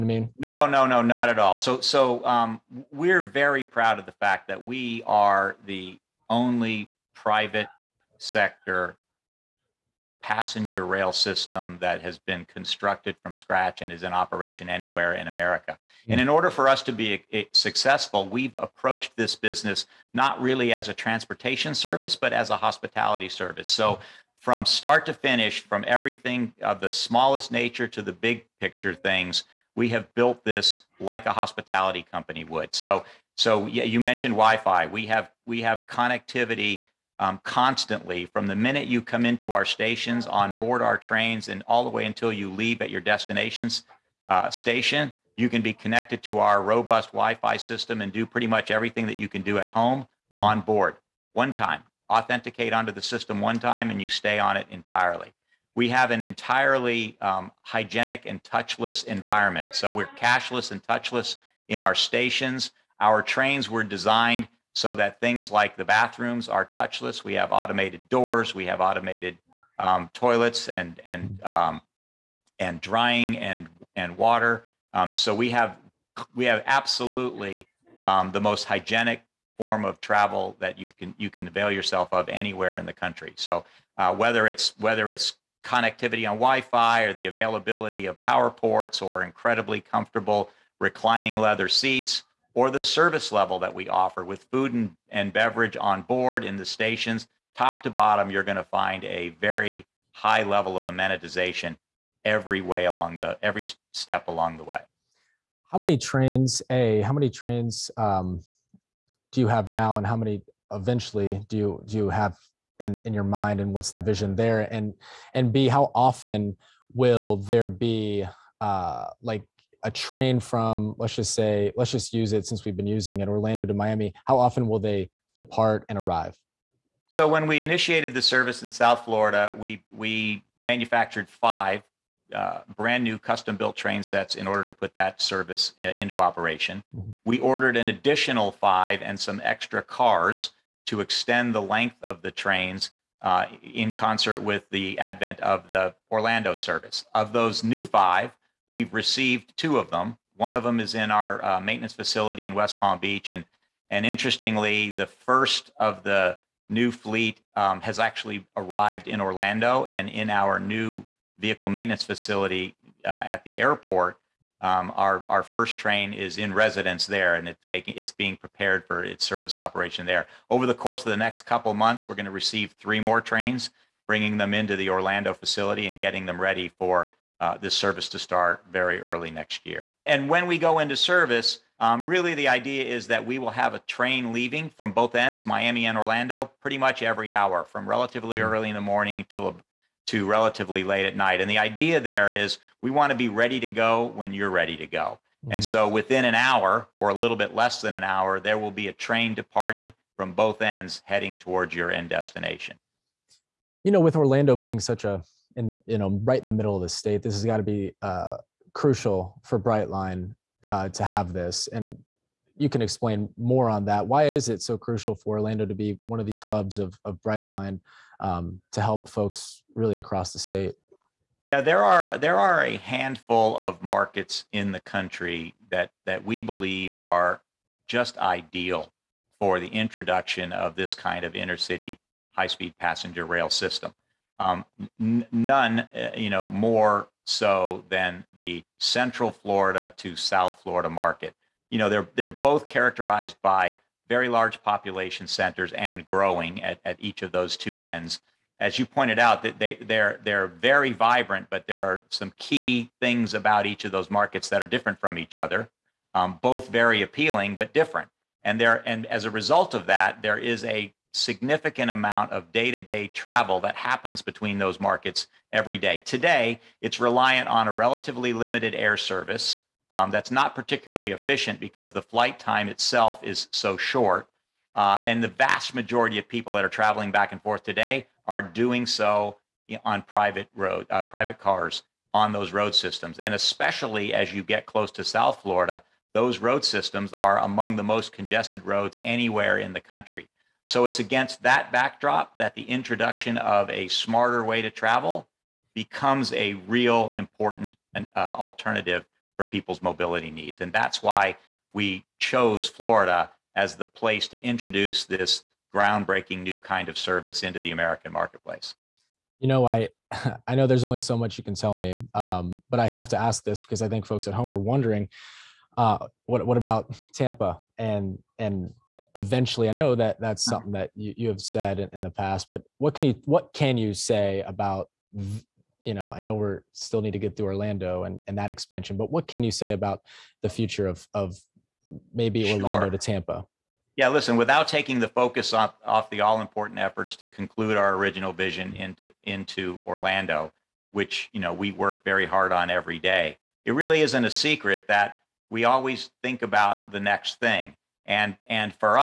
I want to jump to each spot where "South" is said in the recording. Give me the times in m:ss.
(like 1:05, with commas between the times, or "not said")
2:08, 4:00, 4:45.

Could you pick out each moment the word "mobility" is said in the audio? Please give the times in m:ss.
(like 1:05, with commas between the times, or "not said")
4:59.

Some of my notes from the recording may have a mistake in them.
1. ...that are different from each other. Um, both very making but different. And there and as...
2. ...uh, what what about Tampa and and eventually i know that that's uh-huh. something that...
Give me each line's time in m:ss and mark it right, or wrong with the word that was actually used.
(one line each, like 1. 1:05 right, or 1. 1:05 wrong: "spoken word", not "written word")
1. 4:14 wrong: "appealing", not "making"
2. 5:15 right.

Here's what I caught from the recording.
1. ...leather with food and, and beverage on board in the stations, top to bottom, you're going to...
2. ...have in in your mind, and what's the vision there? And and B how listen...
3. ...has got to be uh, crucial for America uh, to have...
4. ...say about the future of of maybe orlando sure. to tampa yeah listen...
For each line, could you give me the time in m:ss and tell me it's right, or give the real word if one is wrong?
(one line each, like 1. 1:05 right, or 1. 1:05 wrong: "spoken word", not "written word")
1. 1:33 wrong: "offer", not "leather"
2. 1:52 wrong: "often", not "listen"
3. 3:27 wrong: "Brightline", not "America"
4. 5:29 right.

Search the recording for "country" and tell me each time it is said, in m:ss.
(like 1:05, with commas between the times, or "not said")
1:22, 3:44, 4:49.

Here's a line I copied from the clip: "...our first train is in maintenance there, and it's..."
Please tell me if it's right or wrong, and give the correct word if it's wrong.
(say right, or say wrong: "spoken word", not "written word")
wrong: "residence", not "maintenance".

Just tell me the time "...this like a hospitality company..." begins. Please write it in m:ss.
0:30.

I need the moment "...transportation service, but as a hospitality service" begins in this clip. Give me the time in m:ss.
0:20.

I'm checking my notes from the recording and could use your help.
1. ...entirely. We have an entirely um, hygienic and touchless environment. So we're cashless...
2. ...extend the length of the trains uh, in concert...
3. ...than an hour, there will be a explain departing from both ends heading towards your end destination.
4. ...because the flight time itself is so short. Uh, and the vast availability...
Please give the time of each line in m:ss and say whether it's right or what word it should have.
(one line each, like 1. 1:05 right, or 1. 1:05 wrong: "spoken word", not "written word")
1. 0:54 right
2. 2:20 right
3. 3:17 wrong: "train", not "explain"
4. 4:31 wrong: "majority", not "availability".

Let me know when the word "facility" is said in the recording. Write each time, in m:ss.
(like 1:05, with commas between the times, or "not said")
2:31, 2:42, 2:55.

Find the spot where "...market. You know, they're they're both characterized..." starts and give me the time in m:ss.
4:00.